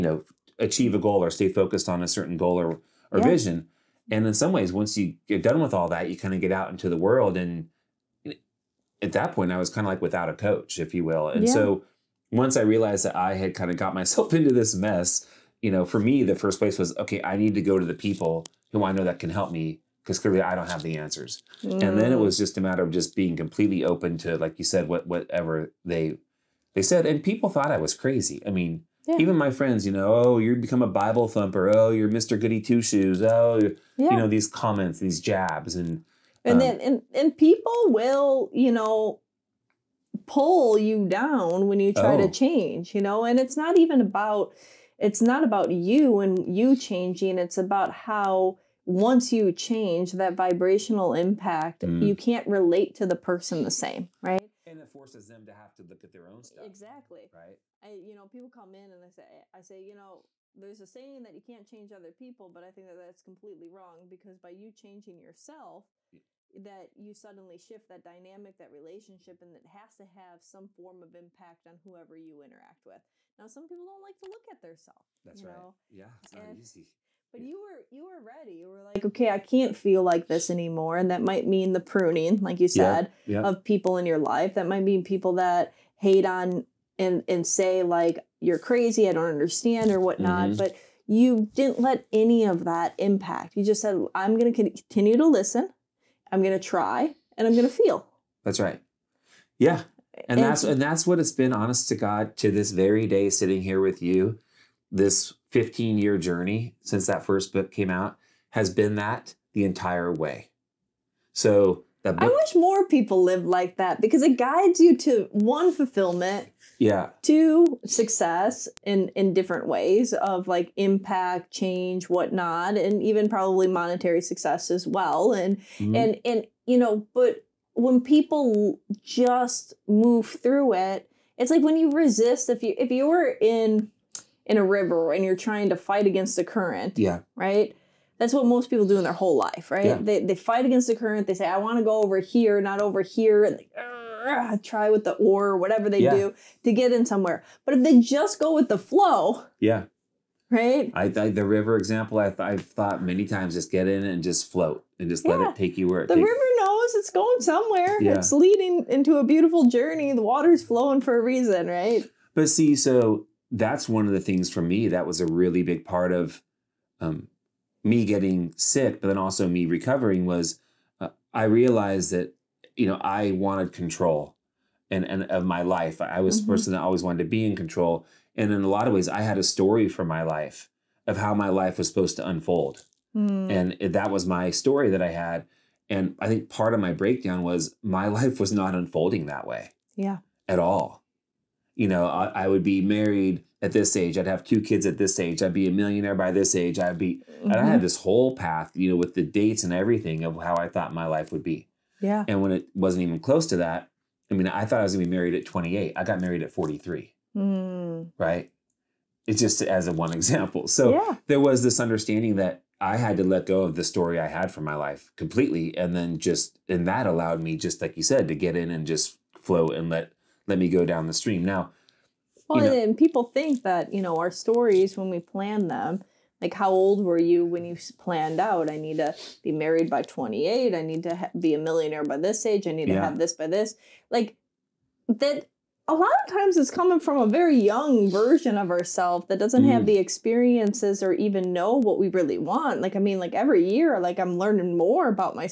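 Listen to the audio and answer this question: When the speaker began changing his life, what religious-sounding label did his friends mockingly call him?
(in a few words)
Bible thumper.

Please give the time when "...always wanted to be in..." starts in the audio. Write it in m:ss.
2:56.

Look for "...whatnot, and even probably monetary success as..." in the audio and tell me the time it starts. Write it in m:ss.
2:02.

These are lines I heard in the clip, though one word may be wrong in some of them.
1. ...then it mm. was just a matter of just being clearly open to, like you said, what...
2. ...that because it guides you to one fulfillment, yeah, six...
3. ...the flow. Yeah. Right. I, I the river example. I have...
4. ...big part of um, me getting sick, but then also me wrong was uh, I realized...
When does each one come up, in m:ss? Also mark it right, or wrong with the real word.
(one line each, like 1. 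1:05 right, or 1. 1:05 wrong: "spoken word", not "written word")
1. 0:21 wrong: "completely", not "clearly"
2. 1:53 wrong: "two", not "six"
3. 2:28 right
4. 2:45 wrong: "recovering", not "wrong".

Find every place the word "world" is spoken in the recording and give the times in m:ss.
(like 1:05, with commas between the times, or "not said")
0:06.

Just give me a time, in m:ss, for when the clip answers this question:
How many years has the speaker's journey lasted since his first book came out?
1:45.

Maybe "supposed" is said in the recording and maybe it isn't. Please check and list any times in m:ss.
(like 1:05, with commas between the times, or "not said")
3:01.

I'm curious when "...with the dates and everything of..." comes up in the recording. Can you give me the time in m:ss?
3:18.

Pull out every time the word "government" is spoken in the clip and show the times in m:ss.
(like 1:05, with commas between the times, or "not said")
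not said.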